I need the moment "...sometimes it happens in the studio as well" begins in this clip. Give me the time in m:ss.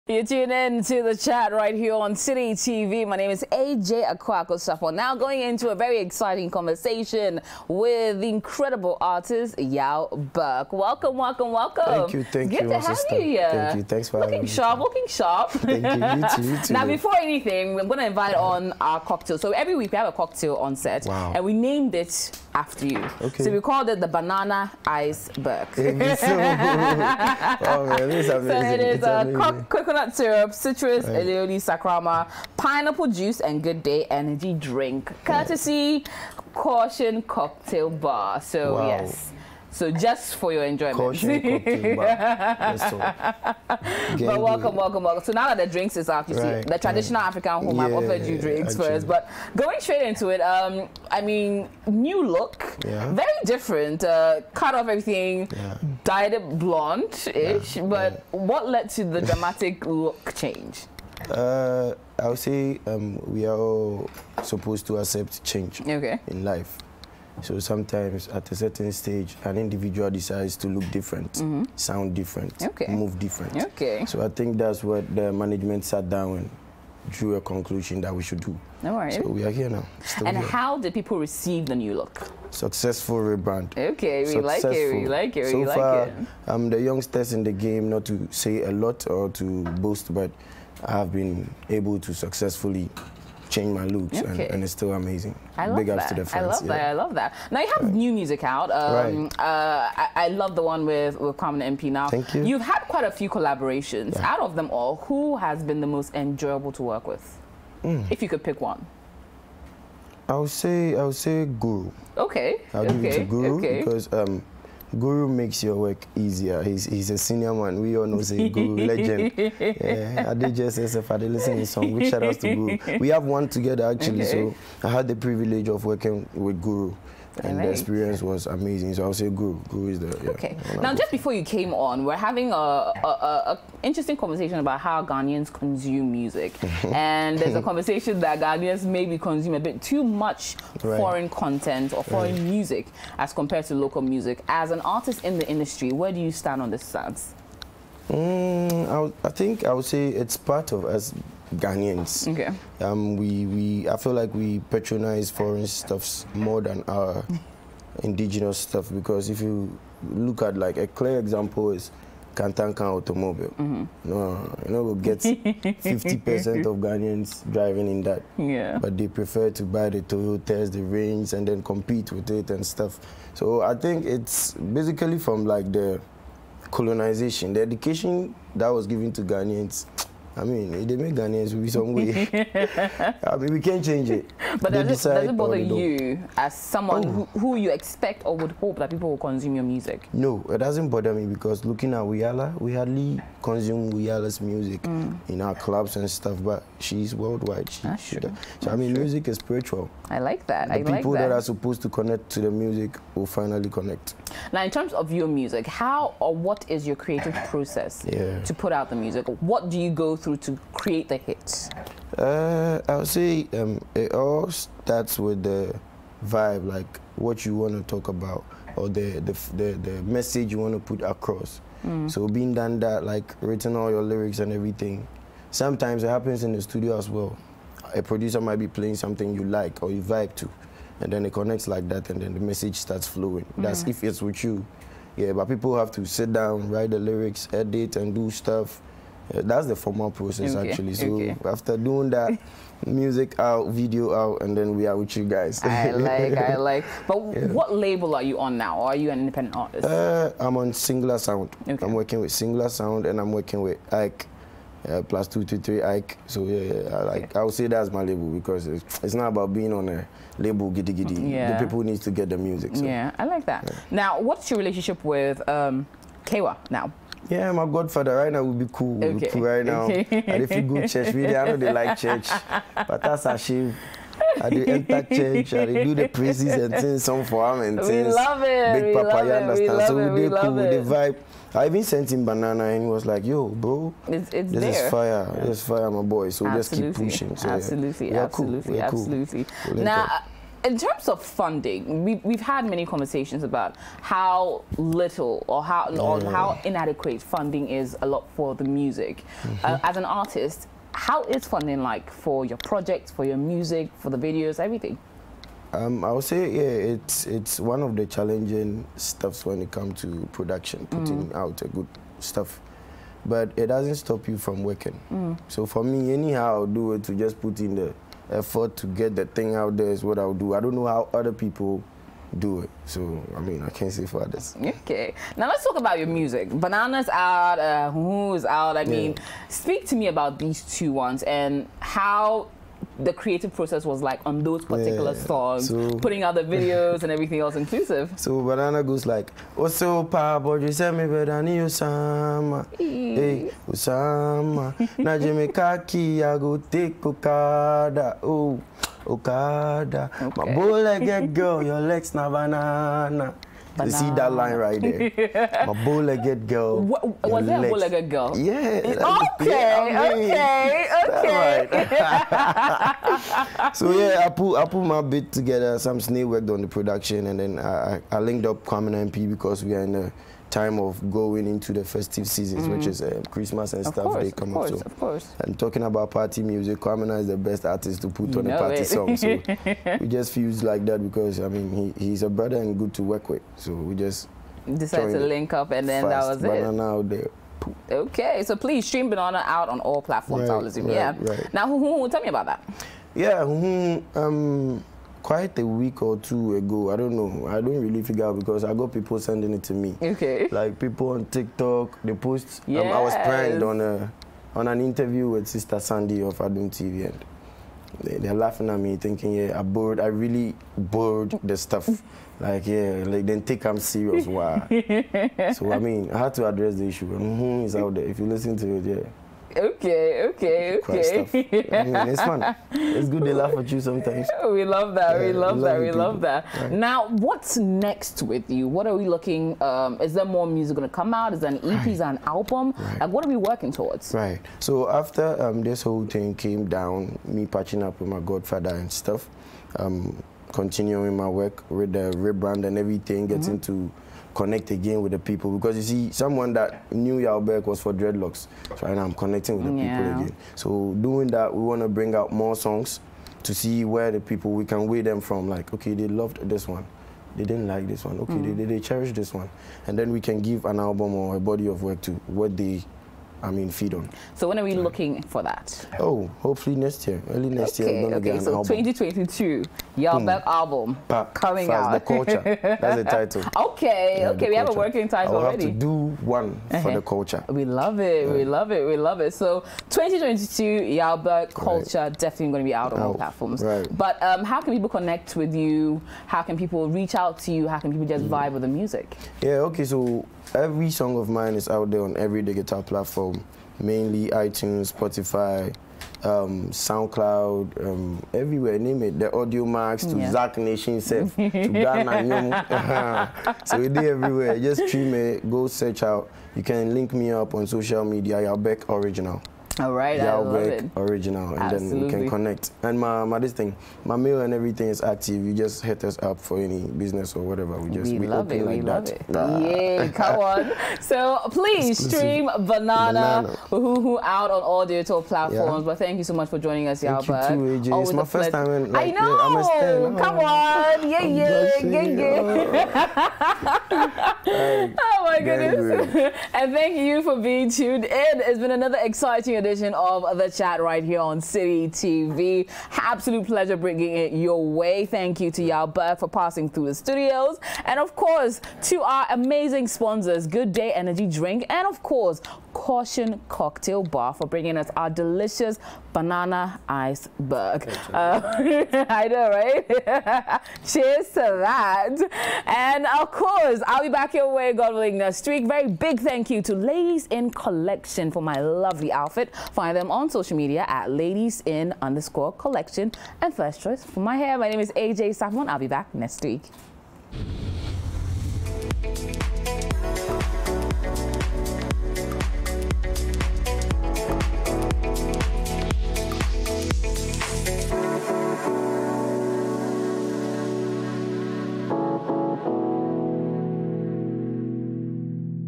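3:45.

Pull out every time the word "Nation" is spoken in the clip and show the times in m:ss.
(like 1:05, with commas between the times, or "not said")
8:20.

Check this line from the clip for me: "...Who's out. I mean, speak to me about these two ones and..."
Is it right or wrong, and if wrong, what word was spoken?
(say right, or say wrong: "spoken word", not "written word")
right.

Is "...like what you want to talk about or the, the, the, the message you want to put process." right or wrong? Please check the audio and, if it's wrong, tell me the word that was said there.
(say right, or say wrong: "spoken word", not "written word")
wrong: "across", not "process".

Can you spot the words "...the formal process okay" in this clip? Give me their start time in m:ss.
3:59.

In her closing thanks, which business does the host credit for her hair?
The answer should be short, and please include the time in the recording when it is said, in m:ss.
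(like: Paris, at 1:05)
First Choice, at 9:33.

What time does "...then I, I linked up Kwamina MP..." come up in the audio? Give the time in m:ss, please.
6:07.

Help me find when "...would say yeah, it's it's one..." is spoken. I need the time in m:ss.
5:06.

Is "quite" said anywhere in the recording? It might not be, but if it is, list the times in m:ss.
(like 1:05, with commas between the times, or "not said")
1:42, 6:35.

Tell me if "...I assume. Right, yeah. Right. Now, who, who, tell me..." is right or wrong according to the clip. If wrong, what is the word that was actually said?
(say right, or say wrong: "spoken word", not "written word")
right.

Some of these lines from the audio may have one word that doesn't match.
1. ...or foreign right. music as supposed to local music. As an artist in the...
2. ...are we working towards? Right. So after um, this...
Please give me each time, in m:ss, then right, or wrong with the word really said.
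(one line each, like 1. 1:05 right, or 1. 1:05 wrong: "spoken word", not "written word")
1. 2:21 wrong: "compared", not "supposed"
2. 7:13 right.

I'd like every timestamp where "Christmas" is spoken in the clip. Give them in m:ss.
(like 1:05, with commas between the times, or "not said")
6:13.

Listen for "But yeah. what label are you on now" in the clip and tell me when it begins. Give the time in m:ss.
4:07.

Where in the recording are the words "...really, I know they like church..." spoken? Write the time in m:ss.
4:31.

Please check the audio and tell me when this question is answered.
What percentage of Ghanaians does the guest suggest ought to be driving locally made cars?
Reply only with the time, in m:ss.
2:45.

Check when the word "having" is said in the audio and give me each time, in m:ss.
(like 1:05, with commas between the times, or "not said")
0:14, 2:12.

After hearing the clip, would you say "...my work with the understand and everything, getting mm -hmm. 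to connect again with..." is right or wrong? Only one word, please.
wrong.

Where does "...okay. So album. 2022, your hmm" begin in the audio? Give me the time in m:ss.
7:48.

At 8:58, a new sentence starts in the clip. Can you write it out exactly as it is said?
It's been another exciting edition of The Chat right here on Citi TV.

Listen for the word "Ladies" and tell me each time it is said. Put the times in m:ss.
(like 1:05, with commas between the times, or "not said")
9:26, 9:31.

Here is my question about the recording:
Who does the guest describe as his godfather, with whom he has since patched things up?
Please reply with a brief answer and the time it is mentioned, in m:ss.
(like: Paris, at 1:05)
Kewa, at 4:26.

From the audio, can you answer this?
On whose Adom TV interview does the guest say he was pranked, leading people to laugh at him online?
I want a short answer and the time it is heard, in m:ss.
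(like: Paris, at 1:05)
Sister Sandy, at 6:45.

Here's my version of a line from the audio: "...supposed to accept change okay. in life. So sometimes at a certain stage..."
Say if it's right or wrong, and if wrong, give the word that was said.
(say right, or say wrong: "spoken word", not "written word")
right.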